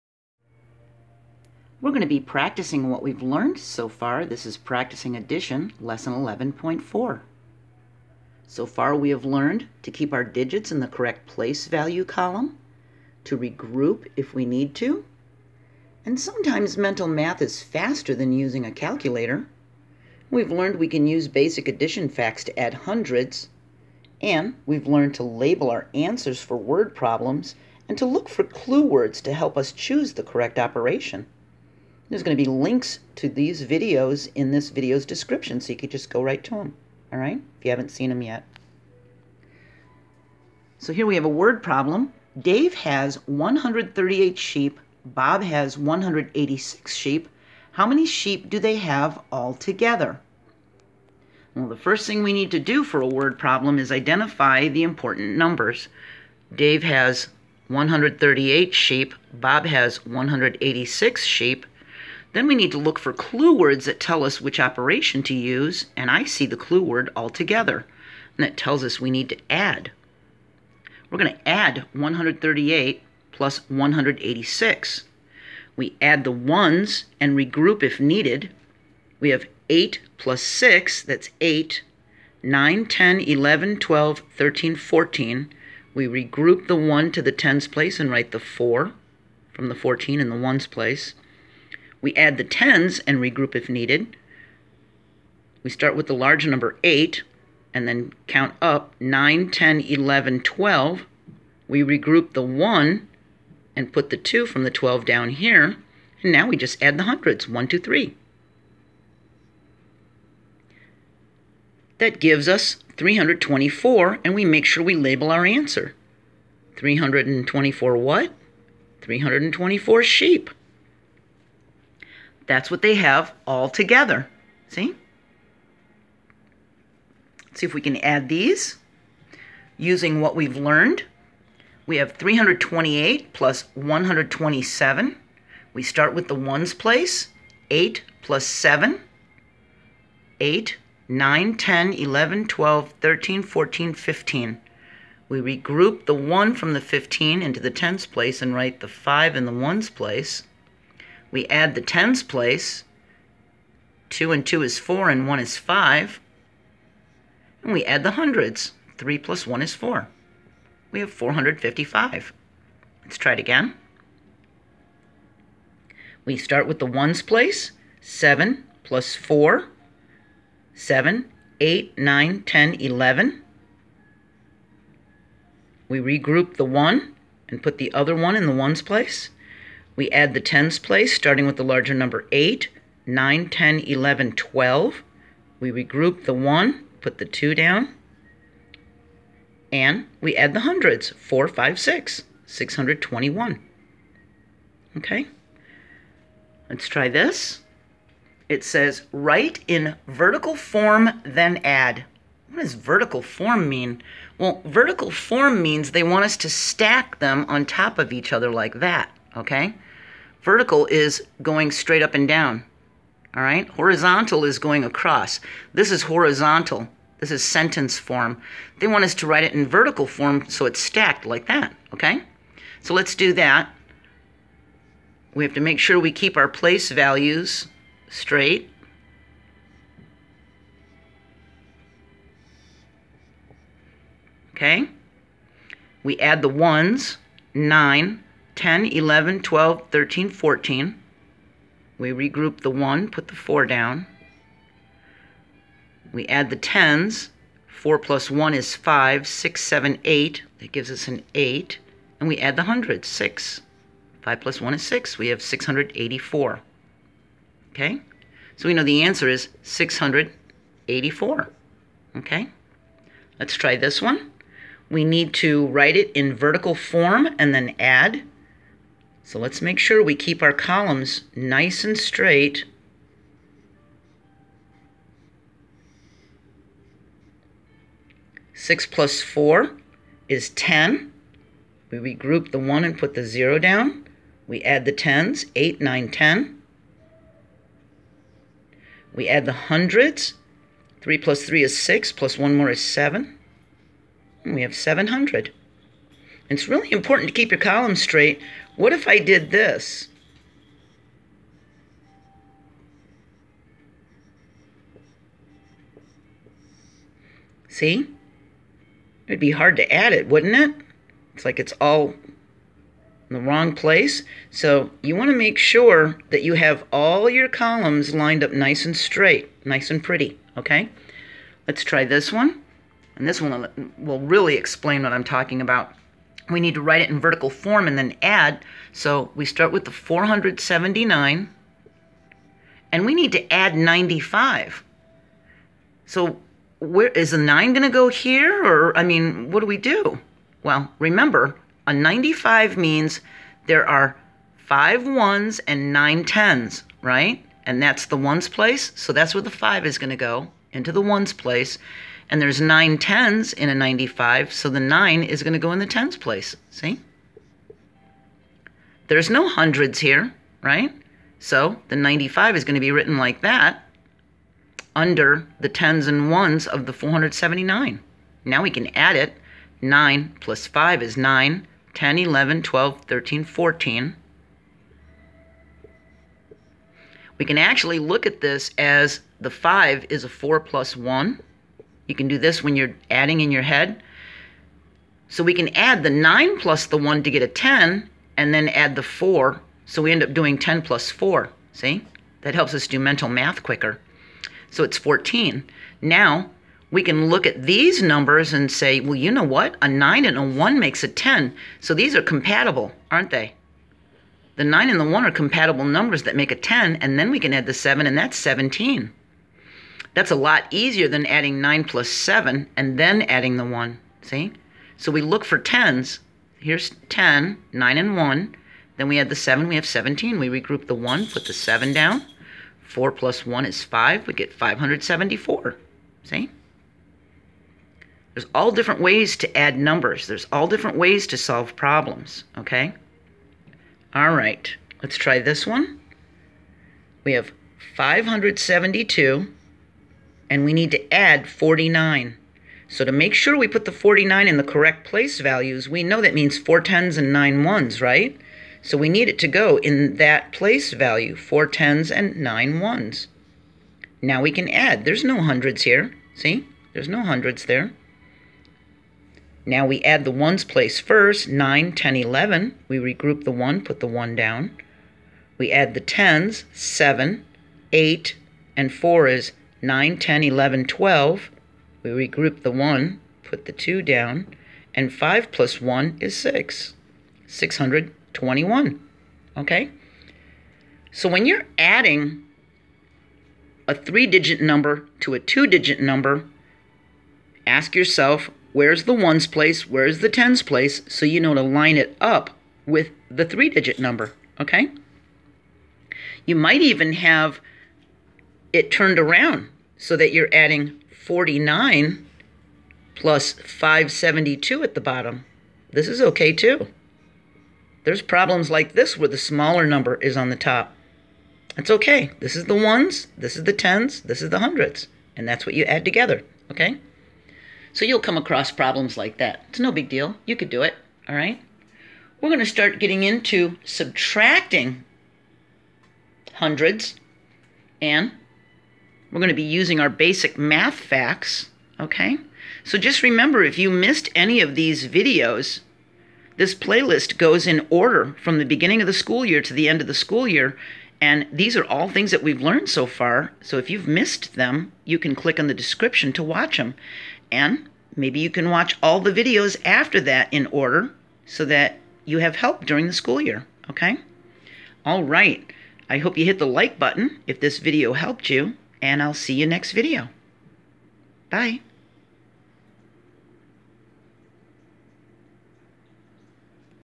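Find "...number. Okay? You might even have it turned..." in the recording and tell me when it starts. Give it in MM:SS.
08:13.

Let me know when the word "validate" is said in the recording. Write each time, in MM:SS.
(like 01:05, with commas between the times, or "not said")
not said.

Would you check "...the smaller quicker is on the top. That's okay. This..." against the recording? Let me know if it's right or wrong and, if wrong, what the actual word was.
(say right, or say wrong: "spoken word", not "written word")
wrong: "number", not "quicker".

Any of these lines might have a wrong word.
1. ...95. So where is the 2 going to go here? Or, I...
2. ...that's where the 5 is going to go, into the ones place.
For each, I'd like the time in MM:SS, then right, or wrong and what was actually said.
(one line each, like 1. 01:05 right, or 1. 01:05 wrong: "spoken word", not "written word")
1. 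05:33 wrong: "9", not "2"
2. 05:49 right.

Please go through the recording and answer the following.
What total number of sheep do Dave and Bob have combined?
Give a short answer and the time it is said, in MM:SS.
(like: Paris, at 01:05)
324 sheep, at 01:59.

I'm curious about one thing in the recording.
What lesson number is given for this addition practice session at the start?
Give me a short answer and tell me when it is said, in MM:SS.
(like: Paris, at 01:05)
11.4, at 00:05.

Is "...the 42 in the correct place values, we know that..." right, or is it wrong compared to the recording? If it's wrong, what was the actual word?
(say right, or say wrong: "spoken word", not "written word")
wrong: "49", not "42".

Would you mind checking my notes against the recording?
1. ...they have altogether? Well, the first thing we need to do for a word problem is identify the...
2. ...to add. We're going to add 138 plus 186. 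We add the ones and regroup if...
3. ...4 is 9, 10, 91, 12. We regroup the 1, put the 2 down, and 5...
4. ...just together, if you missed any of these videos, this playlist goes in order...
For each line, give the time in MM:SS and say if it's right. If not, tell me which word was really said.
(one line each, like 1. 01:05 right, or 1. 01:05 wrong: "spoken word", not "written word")
1. 00:48 right
2. 01:09 right
3. 07:48 wrong: "11", not "91"
4. 08:52 wrong: "remember", not "together".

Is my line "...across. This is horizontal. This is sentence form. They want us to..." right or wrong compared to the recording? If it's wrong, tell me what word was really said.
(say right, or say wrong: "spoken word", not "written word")
right.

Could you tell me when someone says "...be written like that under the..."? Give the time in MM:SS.
06:02.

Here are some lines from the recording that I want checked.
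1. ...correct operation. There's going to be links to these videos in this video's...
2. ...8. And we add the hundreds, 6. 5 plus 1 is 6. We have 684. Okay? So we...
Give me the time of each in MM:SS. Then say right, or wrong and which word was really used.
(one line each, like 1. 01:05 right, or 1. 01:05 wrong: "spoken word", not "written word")
1. 00:30 right
2. 04:11 right.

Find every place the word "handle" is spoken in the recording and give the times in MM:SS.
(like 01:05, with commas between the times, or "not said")
not said.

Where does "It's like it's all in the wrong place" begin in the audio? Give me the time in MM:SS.
05:11.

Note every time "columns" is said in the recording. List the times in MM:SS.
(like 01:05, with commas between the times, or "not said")
00:12, 04:30, 04:57, 05:17.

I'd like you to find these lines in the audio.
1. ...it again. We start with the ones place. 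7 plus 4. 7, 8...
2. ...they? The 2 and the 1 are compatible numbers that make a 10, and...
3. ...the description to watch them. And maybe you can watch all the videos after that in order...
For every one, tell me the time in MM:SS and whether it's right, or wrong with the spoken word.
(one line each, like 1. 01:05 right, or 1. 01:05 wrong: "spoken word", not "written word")
1. 02:43 right
2. 06:43 wrong: "9", not "2"
3. 09:05 right.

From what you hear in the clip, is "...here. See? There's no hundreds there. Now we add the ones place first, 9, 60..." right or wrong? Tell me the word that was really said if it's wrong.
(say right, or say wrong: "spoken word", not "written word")
wrong: "10", not "60".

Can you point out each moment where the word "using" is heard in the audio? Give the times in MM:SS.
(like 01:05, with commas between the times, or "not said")
00:18, 02:09, 08:49.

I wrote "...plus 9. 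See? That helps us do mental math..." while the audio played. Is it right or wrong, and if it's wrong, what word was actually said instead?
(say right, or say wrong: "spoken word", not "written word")
wrong: "4", not "9".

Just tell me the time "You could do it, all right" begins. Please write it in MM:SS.
08:40.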